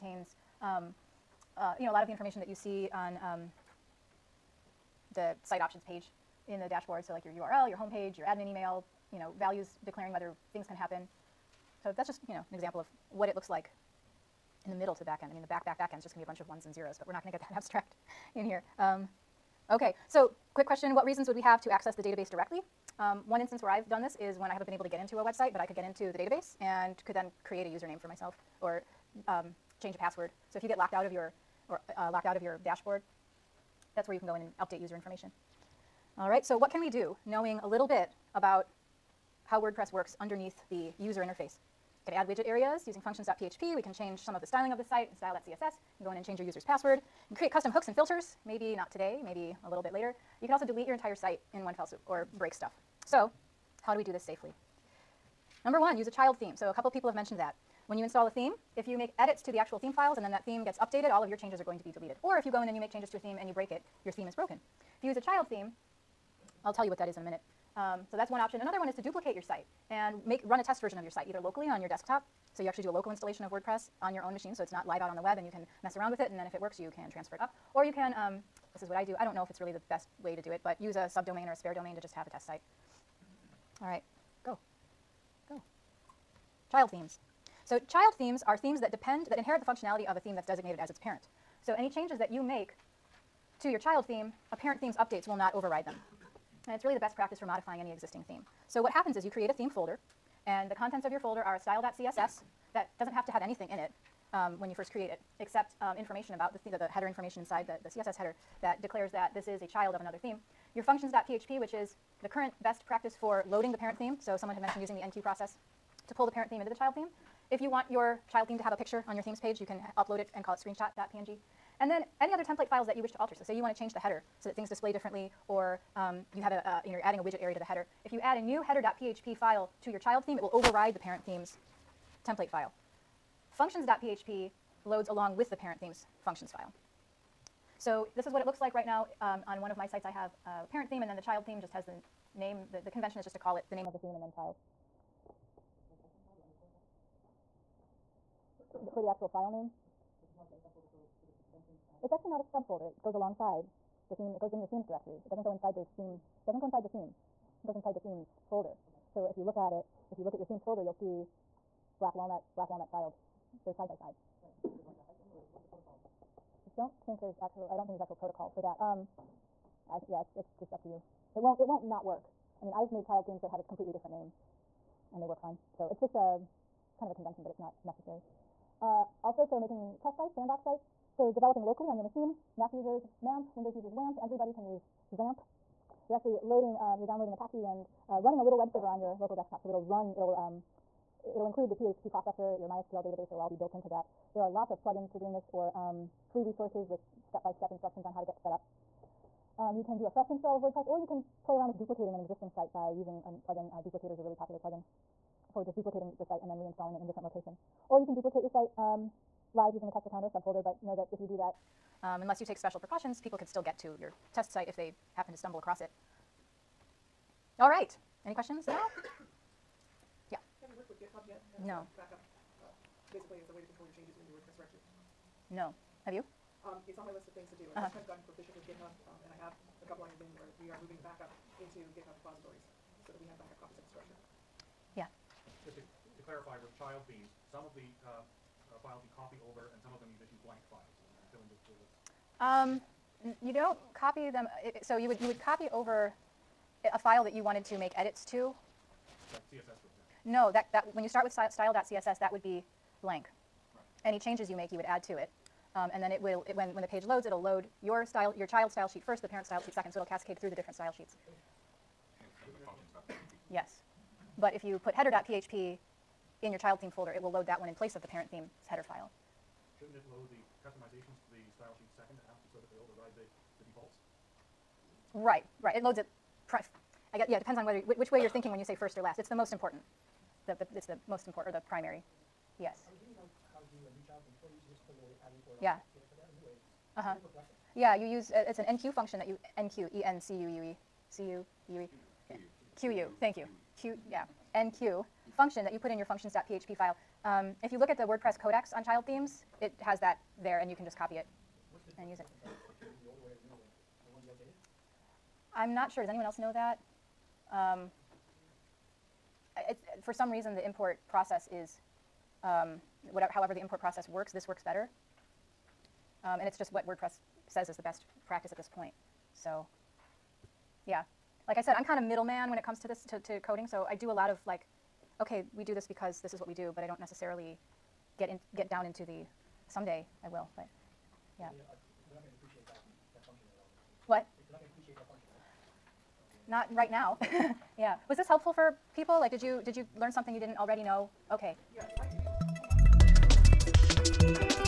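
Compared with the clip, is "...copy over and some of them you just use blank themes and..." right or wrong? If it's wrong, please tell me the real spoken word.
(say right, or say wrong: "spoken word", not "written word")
wrong: "files", not "themes".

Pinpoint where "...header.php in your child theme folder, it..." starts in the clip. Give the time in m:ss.
4:24.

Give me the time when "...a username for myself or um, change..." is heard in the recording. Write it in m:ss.
0:27.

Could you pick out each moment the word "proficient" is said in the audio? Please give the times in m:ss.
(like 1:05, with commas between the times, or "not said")
3:48.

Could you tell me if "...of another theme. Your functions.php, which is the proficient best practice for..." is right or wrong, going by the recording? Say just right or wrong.
wrong.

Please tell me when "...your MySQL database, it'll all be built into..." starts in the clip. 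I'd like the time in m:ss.
3:12.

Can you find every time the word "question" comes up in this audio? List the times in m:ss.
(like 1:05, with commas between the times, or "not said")
0:20, 3:38.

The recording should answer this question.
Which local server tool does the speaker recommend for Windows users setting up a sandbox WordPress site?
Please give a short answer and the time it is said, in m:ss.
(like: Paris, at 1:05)
WAMP, at 3:03.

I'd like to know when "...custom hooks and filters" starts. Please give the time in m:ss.
0:47.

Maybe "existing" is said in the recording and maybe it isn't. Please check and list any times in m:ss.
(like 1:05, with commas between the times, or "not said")
1:37, 3:22.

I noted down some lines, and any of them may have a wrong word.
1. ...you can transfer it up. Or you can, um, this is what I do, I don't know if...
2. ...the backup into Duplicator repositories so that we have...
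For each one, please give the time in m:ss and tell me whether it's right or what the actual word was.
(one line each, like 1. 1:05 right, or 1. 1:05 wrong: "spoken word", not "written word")
1. 1:16 right
2. 3:50 wrong: "GitHub", not "Duplicator".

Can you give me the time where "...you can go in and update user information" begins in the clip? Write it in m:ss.
0:34.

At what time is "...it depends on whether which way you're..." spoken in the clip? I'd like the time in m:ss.
4:37.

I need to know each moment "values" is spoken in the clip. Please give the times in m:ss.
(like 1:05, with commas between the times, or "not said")
0:09.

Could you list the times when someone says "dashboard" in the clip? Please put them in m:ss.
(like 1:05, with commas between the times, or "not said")
0:06, 0:32.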